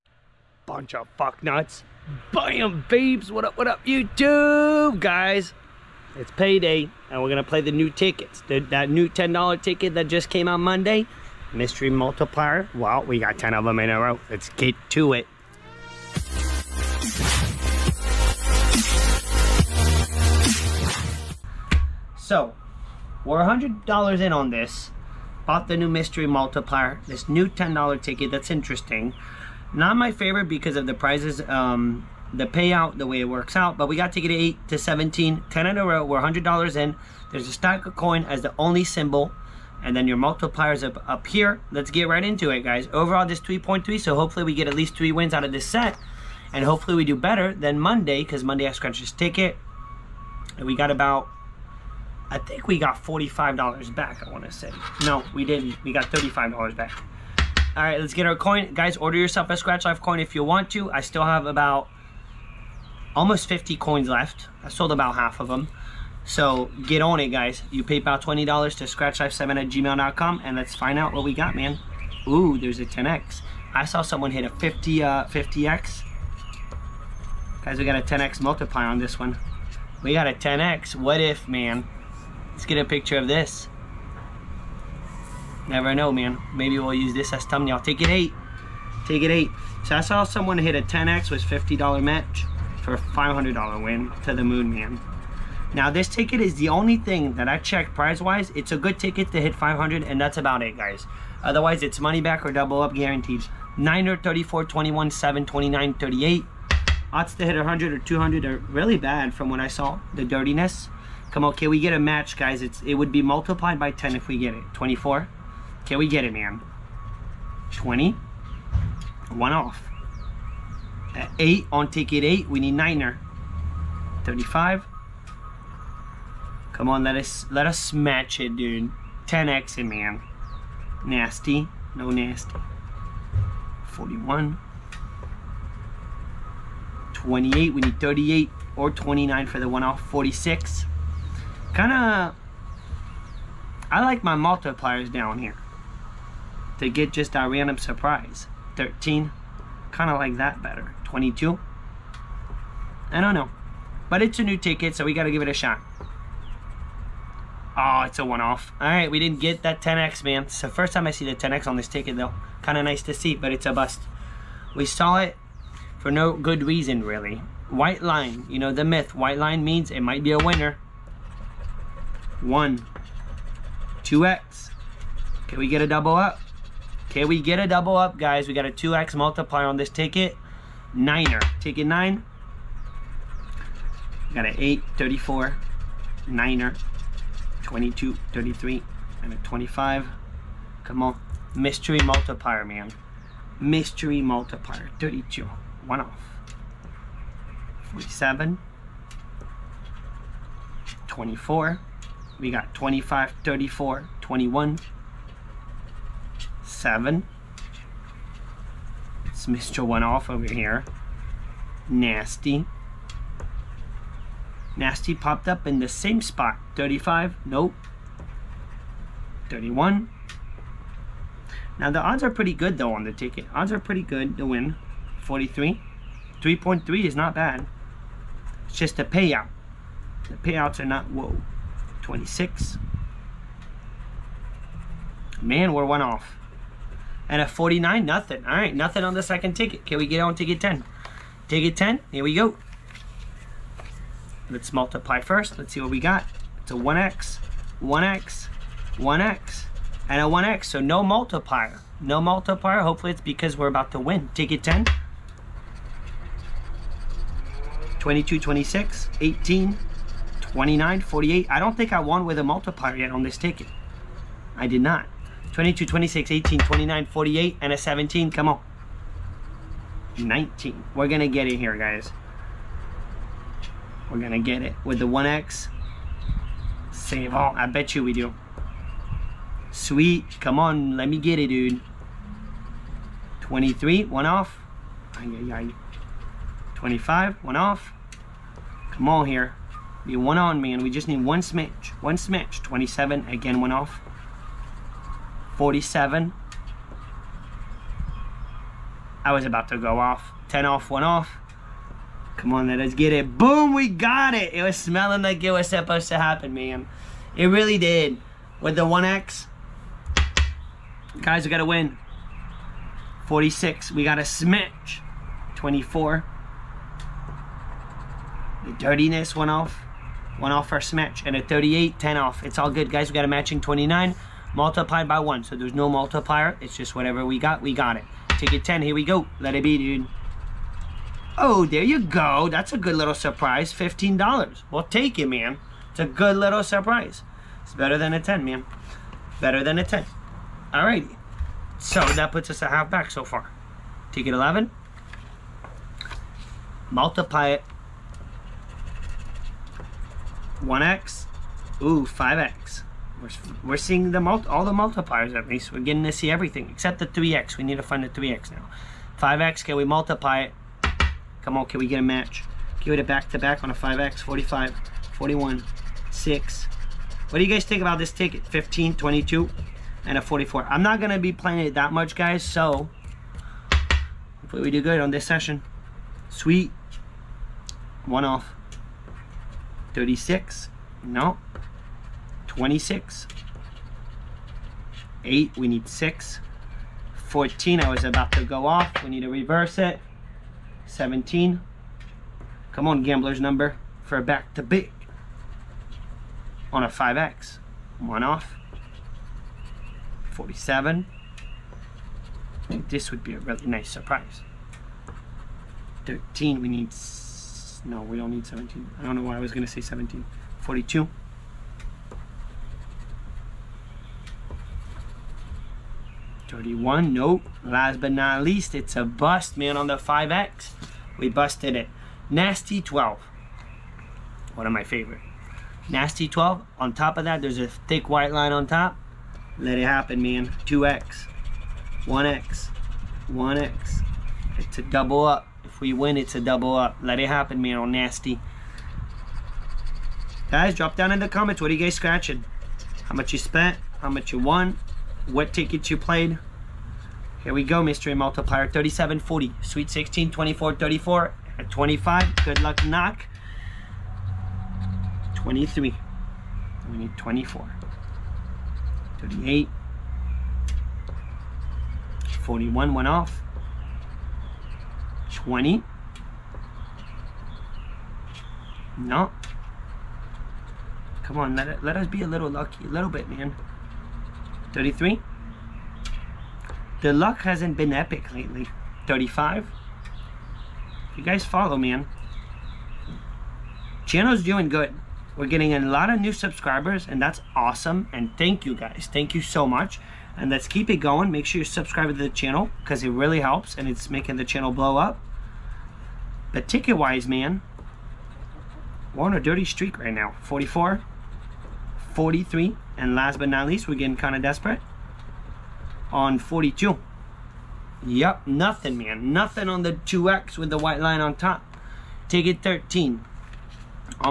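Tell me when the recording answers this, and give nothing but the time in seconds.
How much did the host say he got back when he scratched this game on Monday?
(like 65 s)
55 s.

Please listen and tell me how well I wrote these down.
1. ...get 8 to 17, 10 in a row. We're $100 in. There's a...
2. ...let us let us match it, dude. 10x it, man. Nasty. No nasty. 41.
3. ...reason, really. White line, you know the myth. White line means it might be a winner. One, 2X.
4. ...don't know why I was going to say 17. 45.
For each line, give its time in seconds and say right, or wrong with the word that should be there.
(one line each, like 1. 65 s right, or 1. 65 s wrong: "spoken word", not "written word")
1. 34 s right
2. 127 s right
3. 166 s right
4. 409 s wrong: "42", not "45".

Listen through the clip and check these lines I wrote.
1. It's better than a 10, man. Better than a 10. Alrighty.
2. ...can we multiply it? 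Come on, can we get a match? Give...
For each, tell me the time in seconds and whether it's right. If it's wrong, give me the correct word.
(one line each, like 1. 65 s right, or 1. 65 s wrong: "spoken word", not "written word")
1. 337 s right
2. 359 s right.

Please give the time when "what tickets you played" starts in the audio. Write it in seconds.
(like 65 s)
445 s.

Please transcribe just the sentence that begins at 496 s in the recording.
But ticket wise, man, we're on a dirty streak right now.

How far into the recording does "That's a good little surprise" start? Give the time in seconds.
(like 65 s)
332 s.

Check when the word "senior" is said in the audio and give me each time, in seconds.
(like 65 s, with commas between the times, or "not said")
not said.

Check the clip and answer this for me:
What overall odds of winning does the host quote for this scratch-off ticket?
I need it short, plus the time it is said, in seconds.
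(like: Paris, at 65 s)
3.3, at 43 s.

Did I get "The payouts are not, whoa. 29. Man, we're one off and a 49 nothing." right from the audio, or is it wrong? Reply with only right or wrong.
wrong.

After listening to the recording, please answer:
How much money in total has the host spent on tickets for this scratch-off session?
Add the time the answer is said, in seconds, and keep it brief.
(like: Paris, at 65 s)
$100, at 23 s.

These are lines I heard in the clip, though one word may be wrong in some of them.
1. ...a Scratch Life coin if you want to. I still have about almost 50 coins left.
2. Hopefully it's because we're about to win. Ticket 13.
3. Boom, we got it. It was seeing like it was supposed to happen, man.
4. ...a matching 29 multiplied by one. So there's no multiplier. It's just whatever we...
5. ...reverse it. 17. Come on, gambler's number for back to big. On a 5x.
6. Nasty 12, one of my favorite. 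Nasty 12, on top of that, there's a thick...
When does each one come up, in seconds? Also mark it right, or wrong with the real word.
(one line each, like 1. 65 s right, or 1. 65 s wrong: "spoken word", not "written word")
1. 59 s right
2. 252 s wrong: "10", not "13"
3. 303 s wrong: "smelling", not "seeing"
4. 323 s right
5. 389 s right
6. 422 s right.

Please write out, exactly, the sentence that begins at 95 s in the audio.
Now this ticket is the only thing that I checked prize-wise.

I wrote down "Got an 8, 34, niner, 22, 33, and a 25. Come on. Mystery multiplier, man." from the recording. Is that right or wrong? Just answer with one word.
right.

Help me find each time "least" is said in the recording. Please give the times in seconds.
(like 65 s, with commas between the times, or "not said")
44 s, 355 s, 418 s, 503 s.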